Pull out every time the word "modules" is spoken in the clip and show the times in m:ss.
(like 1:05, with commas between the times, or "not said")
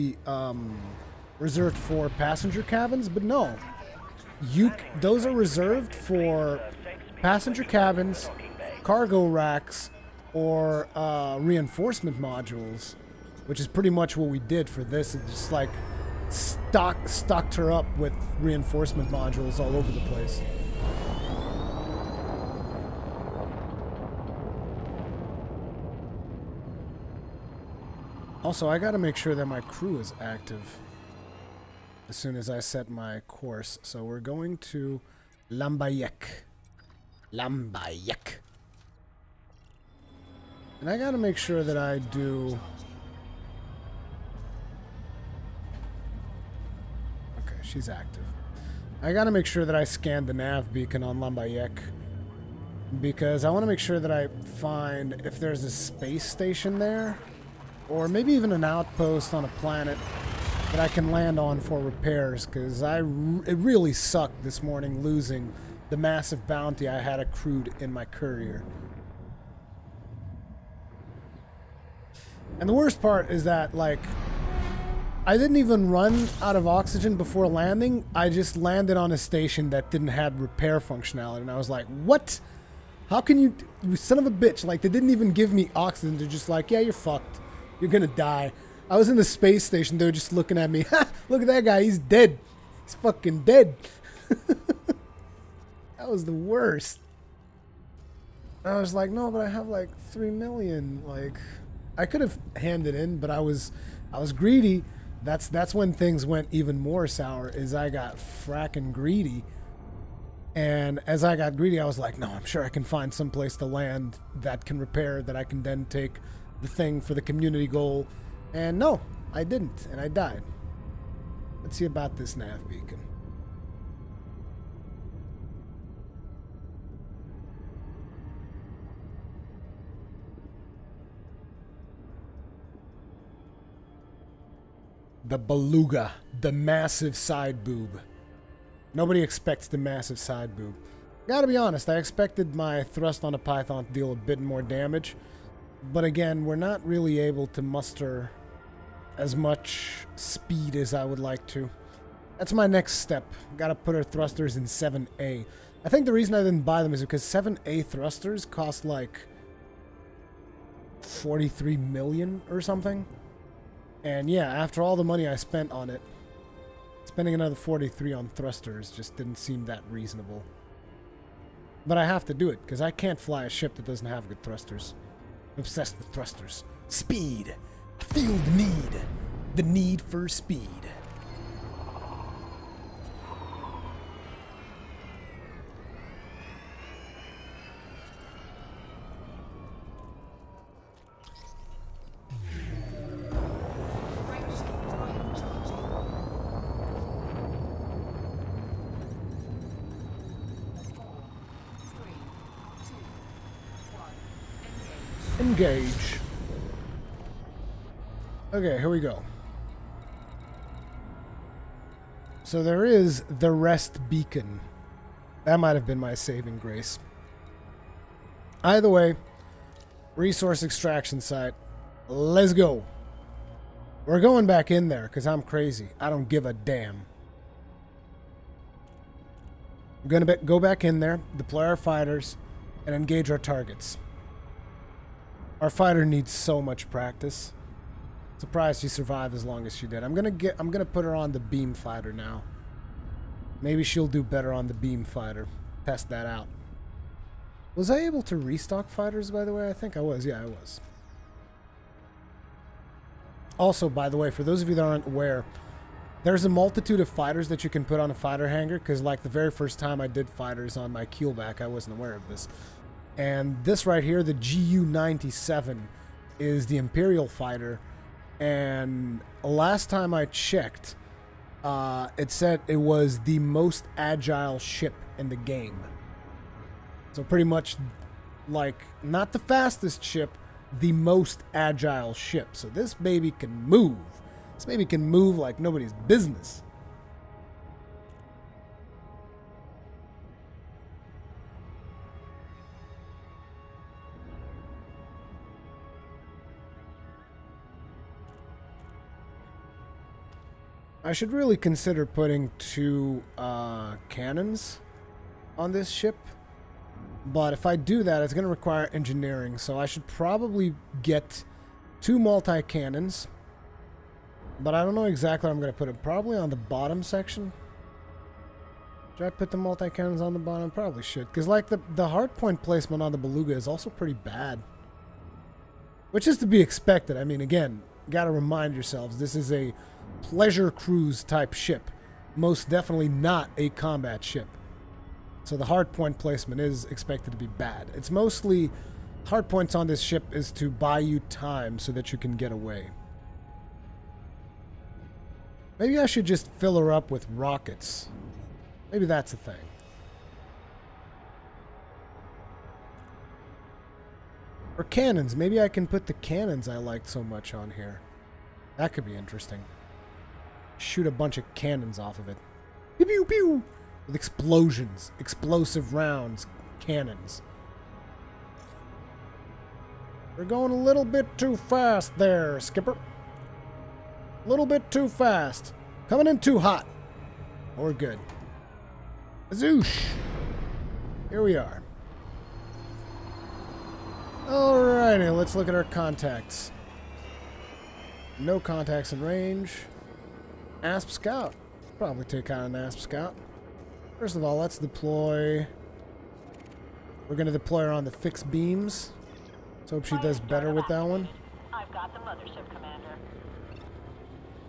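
0:12, 0:19.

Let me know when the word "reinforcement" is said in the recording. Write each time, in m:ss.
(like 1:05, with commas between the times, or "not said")
0:11, 0:18.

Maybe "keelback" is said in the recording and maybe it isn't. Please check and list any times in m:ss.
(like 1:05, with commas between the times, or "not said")
4:21.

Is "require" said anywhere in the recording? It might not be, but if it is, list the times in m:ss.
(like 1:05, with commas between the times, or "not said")
5:08.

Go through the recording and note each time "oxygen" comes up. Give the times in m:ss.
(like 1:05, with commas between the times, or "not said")
1:16, 1:25.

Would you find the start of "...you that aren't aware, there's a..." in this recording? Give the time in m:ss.
4:14.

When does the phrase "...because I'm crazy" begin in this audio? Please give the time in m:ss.
3:45.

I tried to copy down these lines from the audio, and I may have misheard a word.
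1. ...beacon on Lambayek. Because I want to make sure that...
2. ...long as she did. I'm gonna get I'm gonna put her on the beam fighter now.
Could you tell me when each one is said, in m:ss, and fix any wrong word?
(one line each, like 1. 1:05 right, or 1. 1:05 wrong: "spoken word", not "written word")
1. 0:50 right
2. 3:59 right.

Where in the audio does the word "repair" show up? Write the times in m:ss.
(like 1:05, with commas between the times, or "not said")
1:01, 1:20, 1:54.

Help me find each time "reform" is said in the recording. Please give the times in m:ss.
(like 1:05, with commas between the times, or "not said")
not said.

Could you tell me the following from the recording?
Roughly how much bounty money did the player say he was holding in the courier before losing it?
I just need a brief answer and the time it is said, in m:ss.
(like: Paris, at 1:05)
3 million, at 1:40.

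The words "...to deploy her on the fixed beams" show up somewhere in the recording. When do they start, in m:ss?
6:37.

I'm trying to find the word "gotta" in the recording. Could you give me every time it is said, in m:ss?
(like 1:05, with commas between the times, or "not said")
0:28, 0:40, 0:49, 2:21, 2:33.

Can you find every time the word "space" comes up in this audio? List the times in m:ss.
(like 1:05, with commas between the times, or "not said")
0:55, 1:29.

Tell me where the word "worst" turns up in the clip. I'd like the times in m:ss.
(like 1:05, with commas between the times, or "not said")
1:12, 1:36.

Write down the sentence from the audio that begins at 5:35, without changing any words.
So the hardpoint placement is expected to be bad.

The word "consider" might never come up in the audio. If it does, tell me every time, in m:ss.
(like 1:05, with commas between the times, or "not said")
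5:01.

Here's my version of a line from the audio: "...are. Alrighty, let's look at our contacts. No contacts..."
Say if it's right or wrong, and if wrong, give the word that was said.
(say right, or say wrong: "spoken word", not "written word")
right.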